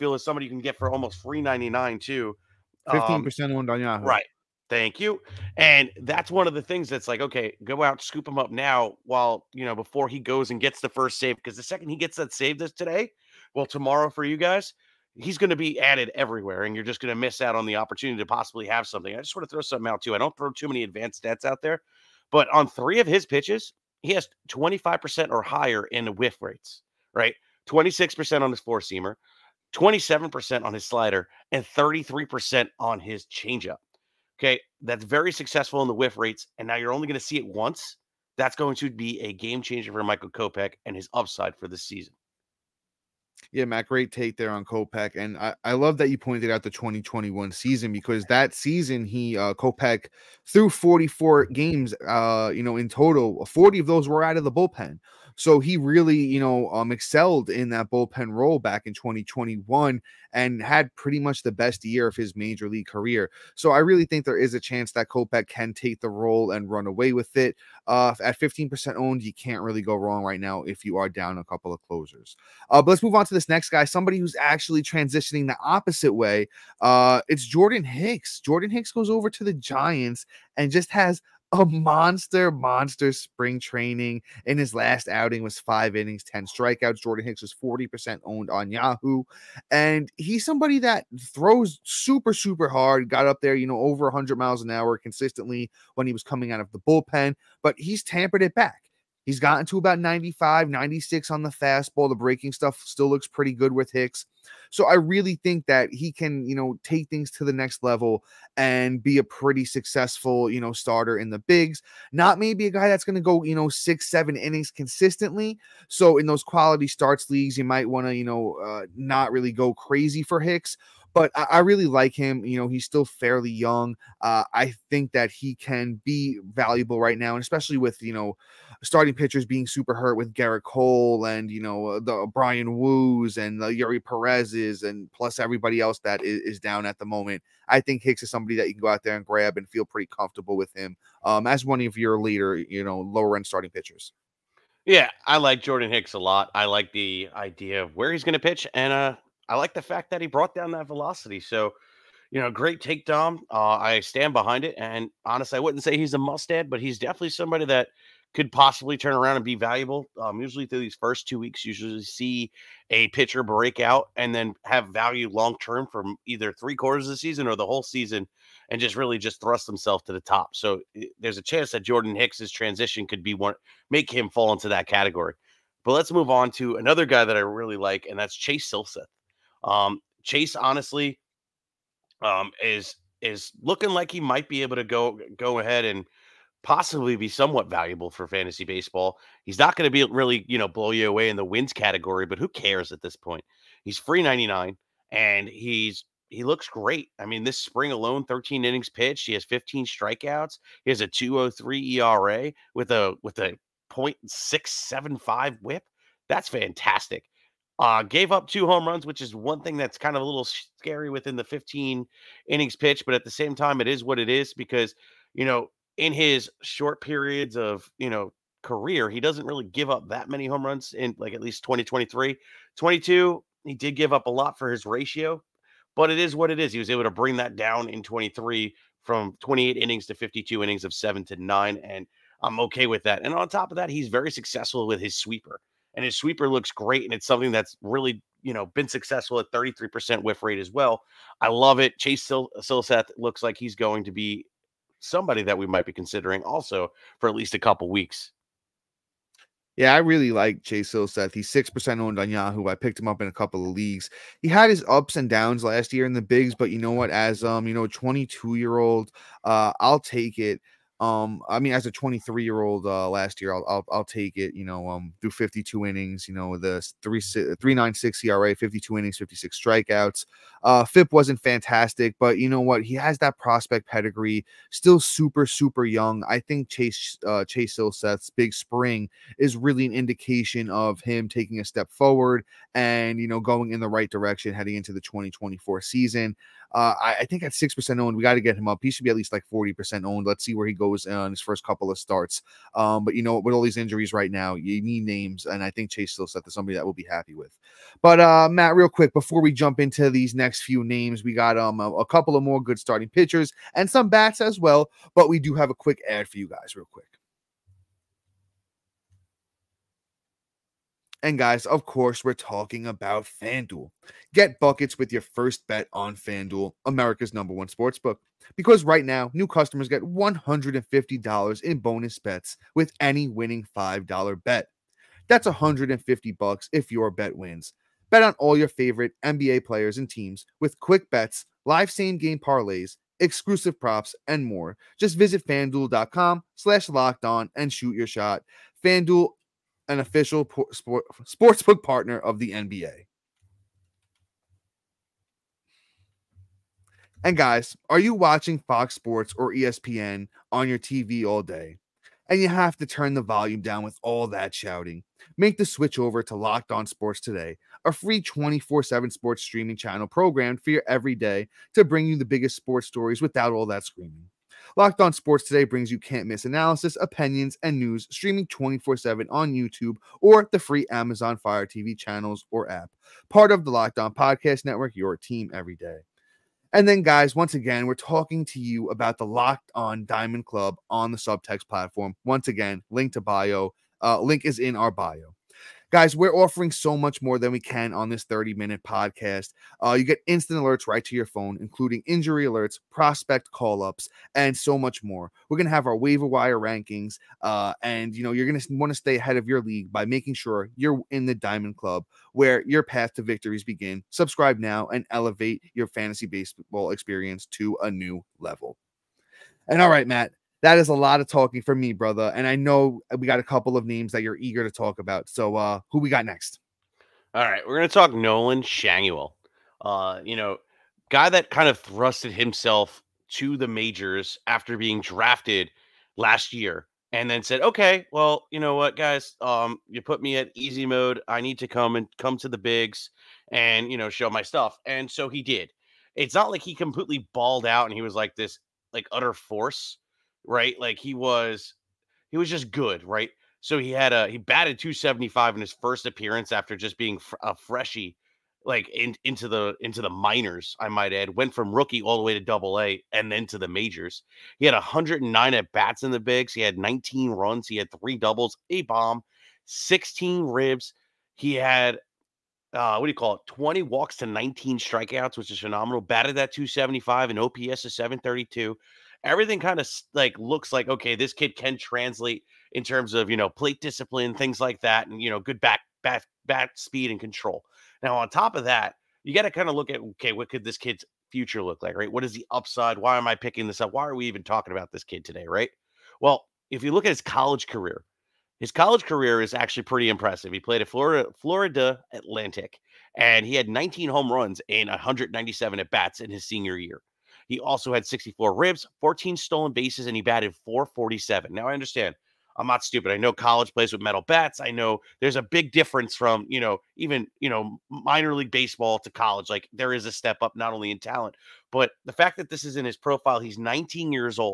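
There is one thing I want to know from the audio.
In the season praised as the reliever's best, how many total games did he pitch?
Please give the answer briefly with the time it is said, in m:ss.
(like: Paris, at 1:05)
44, at 0:50.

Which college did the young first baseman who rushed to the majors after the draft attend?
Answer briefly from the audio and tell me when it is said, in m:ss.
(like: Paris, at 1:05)
Florida Atlantic, at 8:11.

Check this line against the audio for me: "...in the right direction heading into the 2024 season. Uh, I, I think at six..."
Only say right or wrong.
right.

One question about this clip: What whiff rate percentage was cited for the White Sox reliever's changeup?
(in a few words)
33%.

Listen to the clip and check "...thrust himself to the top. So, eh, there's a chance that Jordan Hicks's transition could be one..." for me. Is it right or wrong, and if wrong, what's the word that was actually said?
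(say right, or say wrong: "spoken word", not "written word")
right.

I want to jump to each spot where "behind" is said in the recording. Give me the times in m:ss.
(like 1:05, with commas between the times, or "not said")
2:34.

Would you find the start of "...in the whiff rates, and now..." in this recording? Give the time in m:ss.
0:35.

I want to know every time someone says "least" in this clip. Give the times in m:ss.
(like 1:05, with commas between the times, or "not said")
3:41, 4:07, 4:49.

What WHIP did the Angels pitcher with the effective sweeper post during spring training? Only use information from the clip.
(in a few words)
0.675.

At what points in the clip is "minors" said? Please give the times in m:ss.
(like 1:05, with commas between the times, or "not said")
7:30, 8:27.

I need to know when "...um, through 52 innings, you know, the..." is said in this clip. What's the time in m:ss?
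4:24.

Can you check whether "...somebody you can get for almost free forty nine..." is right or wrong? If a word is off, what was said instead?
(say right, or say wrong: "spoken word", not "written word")
wrong: "ninety", not "forty".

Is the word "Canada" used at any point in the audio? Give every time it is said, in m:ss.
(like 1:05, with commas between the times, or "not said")
not said.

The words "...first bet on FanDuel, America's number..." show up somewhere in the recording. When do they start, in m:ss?
5:15.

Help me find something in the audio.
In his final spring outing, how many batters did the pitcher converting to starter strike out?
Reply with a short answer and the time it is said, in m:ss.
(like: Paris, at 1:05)
10, at 1:26.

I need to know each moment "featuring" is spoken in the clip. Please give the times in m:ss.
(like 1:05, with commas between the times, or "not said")
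not said.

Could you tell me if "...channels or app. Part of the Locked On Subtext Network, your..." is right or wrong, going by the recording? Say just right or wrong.
wrong.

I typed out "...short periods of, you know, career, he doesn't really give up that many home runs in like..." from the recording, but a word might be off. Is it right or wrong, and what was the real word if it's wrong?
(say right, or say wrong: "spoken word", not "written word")
right.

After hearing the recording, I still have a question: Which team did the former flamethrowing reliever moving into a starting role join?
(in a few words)
Giants.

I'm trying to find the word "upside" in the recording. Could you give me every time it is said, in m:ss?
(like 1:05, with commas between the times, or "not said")
0:41, 8:02.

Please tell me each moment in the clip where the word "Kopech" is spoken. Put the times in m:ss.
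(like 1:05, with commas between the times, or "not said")
0:40, 0:44, 0:49, 1:05.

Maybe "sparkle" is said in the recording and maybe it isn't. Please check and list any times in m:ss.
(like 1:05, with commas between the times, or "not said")
not said.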